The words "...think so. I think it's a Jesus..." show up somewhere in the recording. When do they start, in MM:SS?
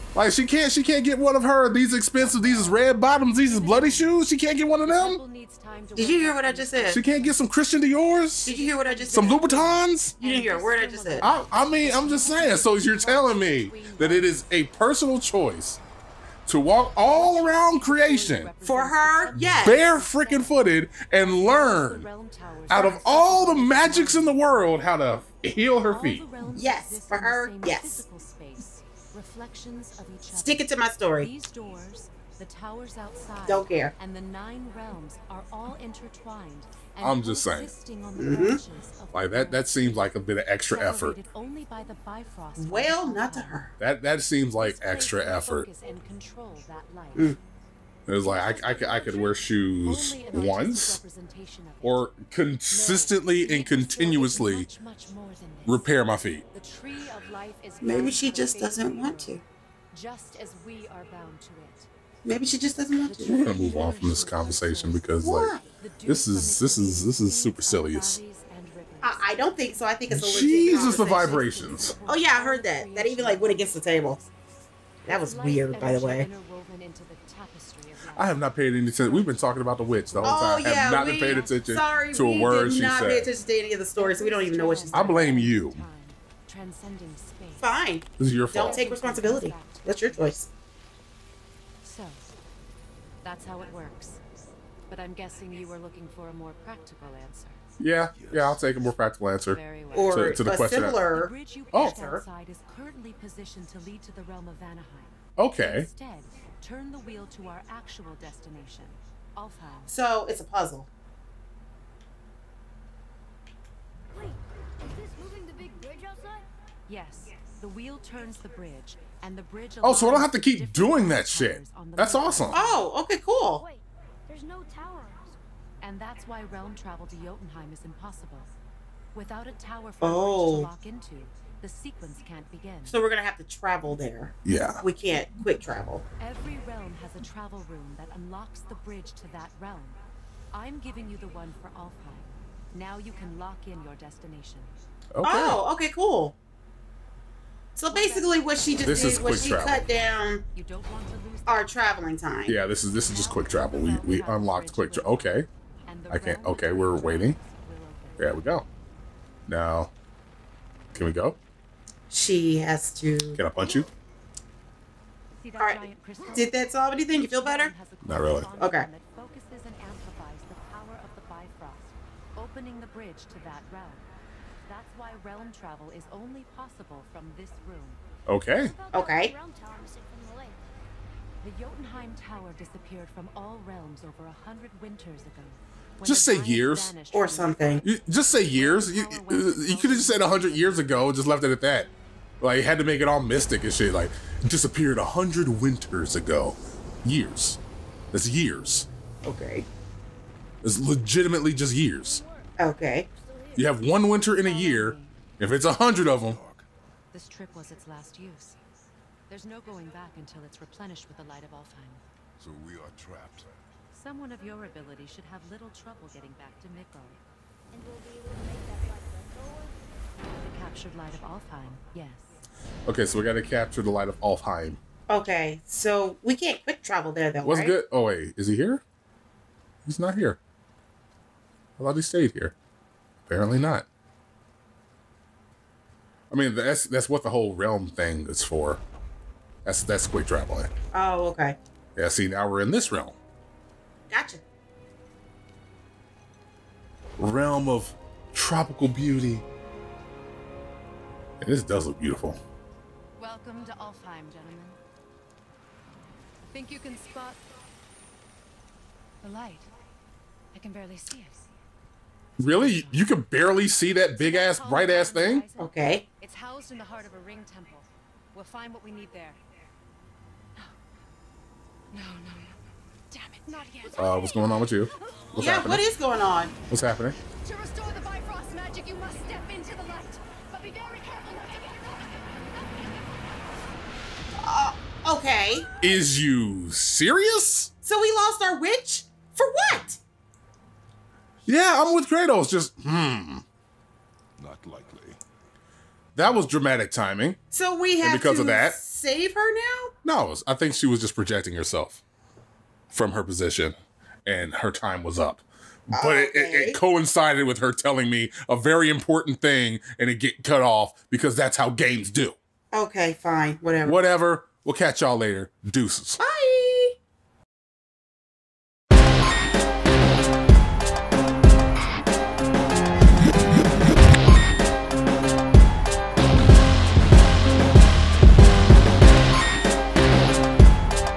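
01:09.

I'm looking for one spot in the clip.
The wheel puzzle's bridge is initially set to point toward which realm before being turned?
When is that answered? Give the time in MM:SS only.
01:44.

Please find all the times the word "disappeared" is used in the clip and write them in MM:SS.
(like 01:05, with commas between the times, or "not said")
03:02, 03:14.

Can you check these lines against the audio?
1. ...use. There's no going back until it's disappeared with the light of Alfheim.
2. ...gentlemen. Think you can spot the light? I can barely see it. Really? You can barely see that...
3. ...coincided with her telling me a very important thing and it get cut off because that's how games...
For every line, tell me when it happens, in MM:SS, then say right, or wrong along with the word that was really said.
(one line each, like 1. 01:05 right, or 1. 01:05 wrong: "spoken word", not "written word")
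1. 03:28 wrong: "replenished", not "disappeared"
2. 04:14 right
3. 05:06 right.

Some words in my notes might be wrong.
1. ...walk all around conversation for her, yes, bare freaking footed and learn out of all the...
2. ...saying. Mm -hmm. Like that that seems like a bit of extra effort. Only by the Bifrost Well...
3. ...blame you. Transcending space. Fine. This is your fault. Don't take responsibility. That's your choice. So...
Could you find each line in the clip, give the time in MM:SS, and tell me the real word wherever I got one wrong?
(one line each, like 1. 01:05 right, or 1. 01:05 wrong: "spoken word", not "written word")
1. 00:16 wrong: "creation", not "conversation"
2. 00:37 right
3. 01:25 right.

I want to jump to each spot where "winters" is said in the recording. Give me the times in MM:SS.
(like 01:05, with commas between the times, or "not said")
03:04, 03:15, 03:24.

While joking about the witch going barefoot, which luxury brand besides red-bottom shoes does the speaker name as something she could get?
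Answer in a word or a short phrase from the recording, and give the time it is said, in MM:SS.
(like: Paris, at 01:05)
Christian Dior, at 00:07.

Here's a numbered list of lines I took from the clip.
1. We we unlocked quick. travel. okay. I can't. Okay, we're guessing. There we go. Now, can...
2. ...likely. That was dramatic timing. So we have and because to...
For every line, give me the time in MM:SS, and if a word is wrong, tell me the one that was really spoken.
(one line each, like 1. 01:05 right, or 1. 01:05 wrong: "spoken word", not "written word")
1. 02:33 wrong: "waiting", not "guessing"
2. 04:54 right.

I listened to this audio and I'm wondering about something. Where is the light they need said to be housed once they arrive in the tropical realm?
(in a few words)
ring temple.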